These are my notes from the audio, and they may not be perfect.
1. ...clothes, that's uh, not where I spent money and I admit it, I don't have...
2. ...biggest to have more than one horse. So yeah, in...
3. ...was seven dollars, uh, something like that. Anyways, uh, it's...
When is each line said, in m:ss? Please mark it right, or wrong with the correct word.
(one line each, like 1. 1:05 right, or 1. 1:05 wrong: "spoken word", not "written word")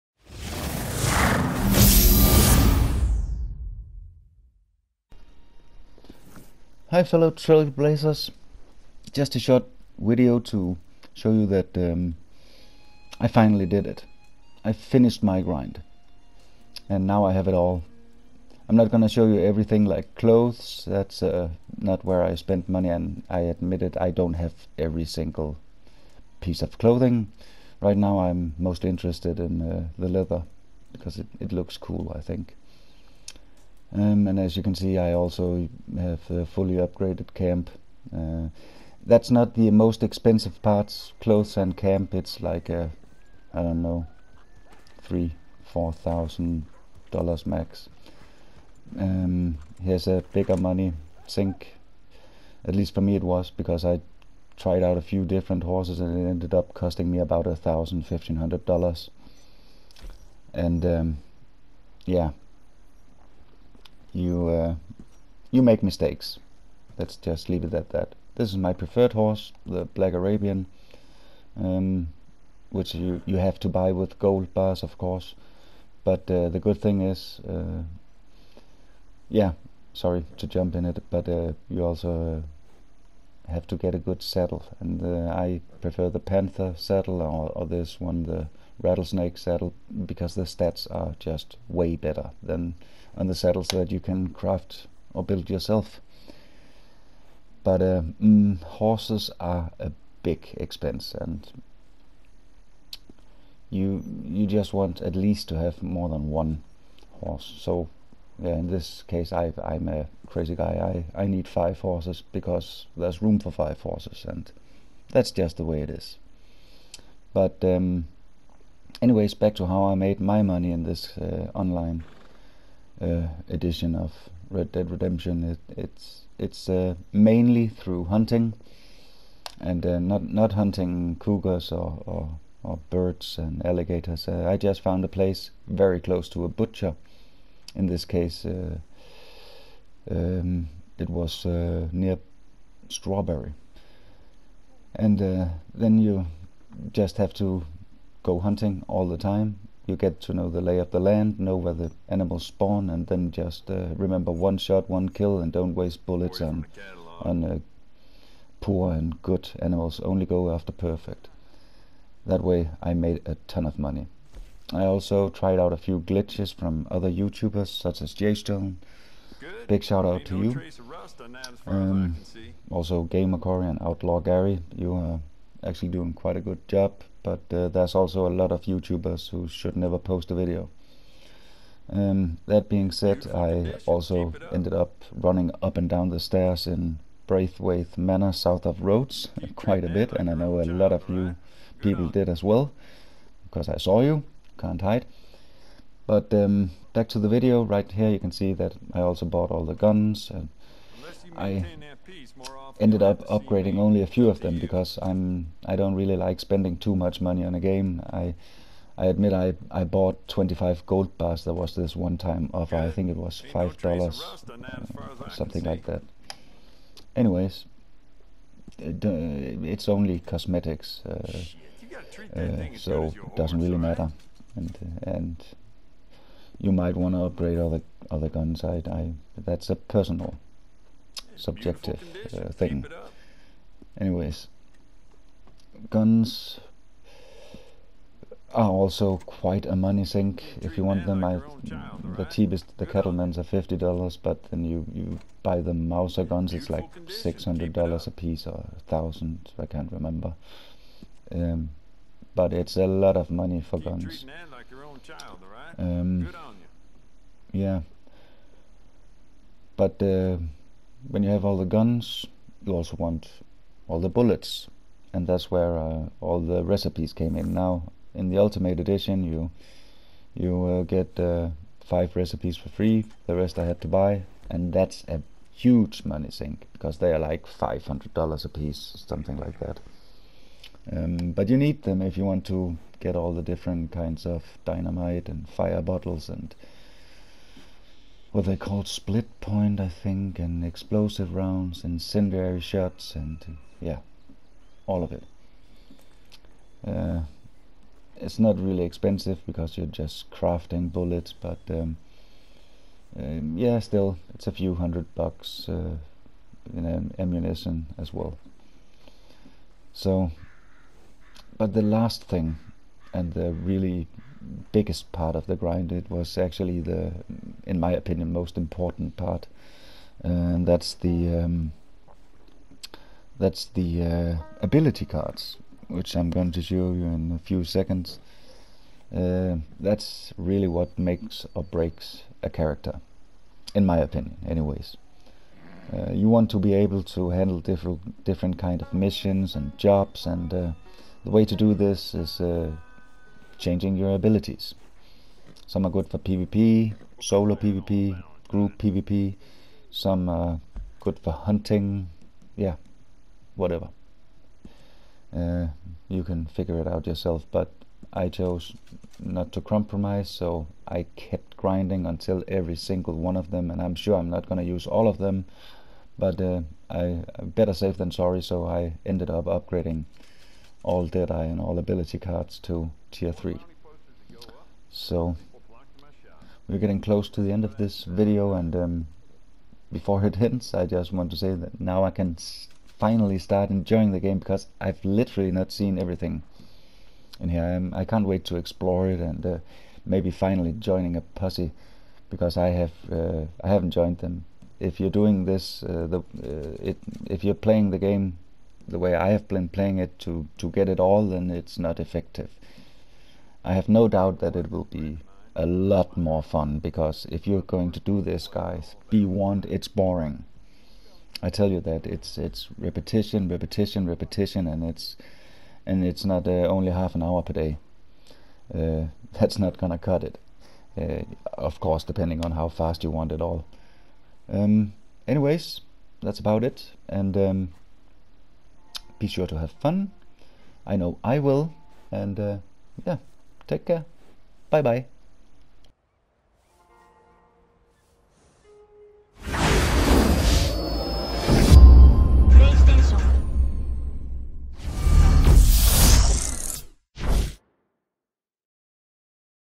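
1. 0:20 right
2. 1:45 wrong: "least", not "biggest"
3. 3:33 wrong: "five", not "seven".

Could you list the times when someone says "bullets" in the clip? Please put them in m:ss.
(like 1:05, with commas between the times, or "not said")
2:36, 4:24, 5:00.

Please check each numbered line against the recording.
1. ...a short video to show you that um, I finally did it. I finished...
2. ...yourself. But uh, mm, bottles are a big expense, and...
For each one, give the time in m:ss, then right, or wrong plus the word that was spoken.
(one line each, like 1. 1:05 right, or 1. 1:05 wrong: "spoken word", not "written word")
1. 0:09 right
2. 1:35 wrong: "horses", not "bottles".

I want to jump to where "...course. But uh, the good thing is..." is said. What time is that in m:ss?
1:14.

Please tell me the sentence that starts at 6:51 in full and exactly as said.
I tell you that it's it's repetition, repetition, repetition, and it's and it's not uh, only half an hour per day.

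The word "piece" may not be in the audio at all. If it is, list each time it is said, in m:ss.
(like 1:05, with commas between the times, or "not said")
0:26, 4:08, 4:38.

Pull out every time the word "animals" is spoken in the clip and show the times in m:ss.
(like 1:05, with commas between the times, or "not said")
2:32, 2:39.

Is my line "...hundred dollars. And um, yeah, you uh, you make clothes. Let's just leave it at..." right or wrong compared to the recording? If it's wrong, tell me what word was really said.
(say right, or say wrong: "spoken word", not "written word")
wrong: "mistakes", not "clothes".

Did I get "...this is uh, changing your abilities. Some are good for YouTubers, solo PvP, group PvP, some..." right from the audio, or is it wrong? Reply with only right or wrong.
wrong.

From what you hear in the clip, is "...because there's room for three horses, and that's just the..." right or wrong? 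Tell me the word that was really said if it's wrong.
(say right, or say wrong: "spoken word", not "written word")
wrong: "five", not "three".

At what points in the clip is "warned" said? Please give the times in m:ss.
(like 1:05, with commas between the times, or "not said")
6:49.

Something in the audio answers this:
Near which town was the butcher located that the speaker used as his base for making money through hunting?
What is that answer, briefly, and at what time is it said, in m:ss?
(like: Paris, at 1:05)
Strawberry, at 2:22.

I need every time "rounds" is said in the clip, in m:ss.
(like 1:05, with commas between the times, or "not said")
4:51.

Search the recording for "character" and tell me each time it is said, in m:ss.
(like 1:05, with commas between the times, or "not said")
5:32.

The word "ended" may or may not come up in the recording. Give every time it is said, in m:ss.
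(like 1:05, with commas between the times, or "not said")
0:56, 3:04, 3:22, 6:09.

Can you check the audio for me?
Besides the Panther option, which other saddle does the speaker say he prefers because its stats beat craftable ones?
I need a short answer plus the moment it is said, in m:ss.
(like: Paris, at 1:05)
Rattlesnake saddle, at 1:28.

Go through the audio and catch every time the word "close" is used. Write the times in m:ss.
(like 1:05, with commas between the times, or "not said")
2:15, 6:17.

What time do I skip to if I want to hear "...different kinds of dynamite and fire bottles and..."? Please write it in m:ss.
4:43.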